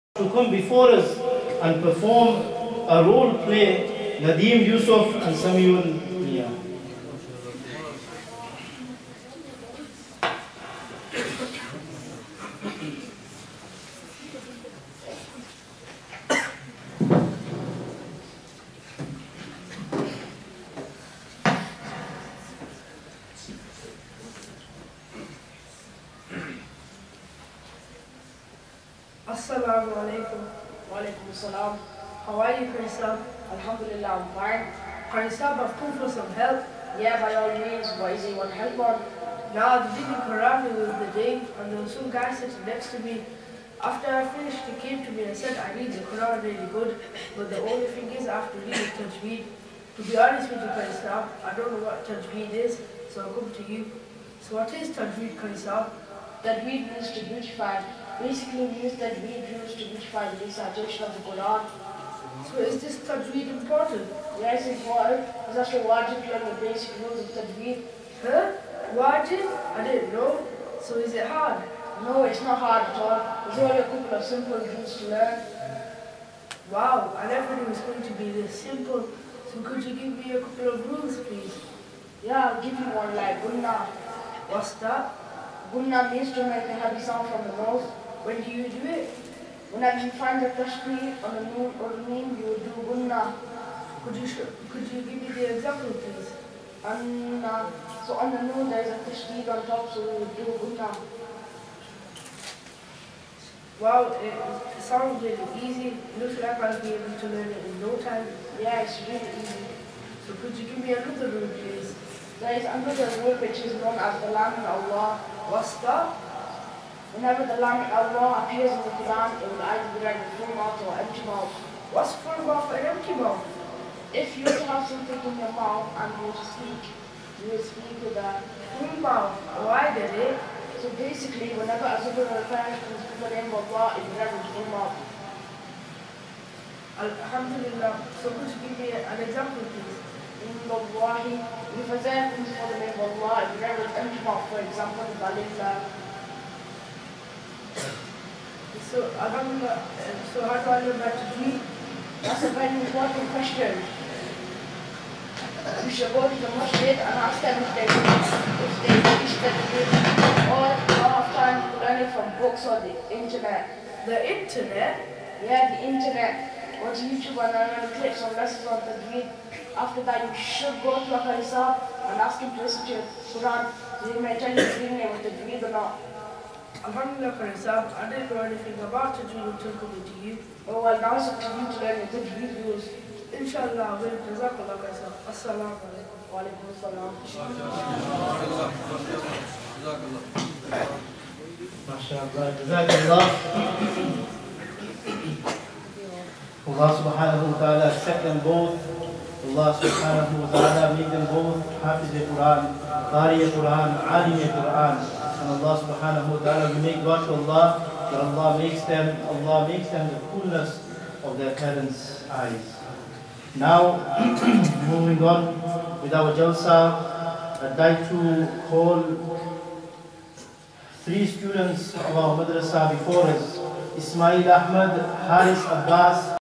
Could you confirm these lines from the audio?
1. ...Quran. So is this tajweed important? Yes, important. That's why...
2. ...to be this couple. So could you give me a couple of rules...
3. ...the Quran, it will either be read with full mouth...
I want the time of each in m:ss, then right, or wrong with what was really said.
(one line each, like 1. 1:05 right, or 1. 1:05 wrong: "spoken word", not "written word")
1. 1:01 right
2. 1:18 wrong: "simple", not "couple"
3. 1:58 right.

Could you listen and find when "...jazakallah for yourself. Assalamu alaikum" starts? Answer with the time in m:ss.
3:04.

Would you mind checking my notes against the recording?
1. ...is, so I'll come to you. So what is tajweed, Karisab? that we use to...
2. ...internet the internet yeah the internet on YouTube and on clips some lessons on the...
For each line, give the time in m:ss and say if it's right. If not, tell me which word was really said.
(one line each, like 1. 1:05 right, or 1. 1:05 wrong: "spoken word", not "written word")
1. 0:52 right
2. 2:43 right.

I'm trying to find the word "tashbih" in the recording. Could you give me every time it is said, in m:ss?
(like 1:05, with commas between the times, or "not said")
1:30, 1:39.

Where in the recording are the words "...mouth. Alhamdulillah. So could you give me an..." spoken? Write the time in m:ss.
2:14.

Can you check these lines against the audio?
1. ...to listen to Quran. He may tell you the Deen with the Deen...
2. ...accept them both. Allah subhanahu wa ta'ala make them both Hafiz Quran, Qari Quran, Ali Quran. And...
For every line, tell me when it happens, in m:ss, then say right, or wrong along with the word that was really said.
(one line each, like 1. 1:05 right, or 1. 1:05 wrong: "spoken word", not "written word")
1. 2:52 right
2. 3:17 right.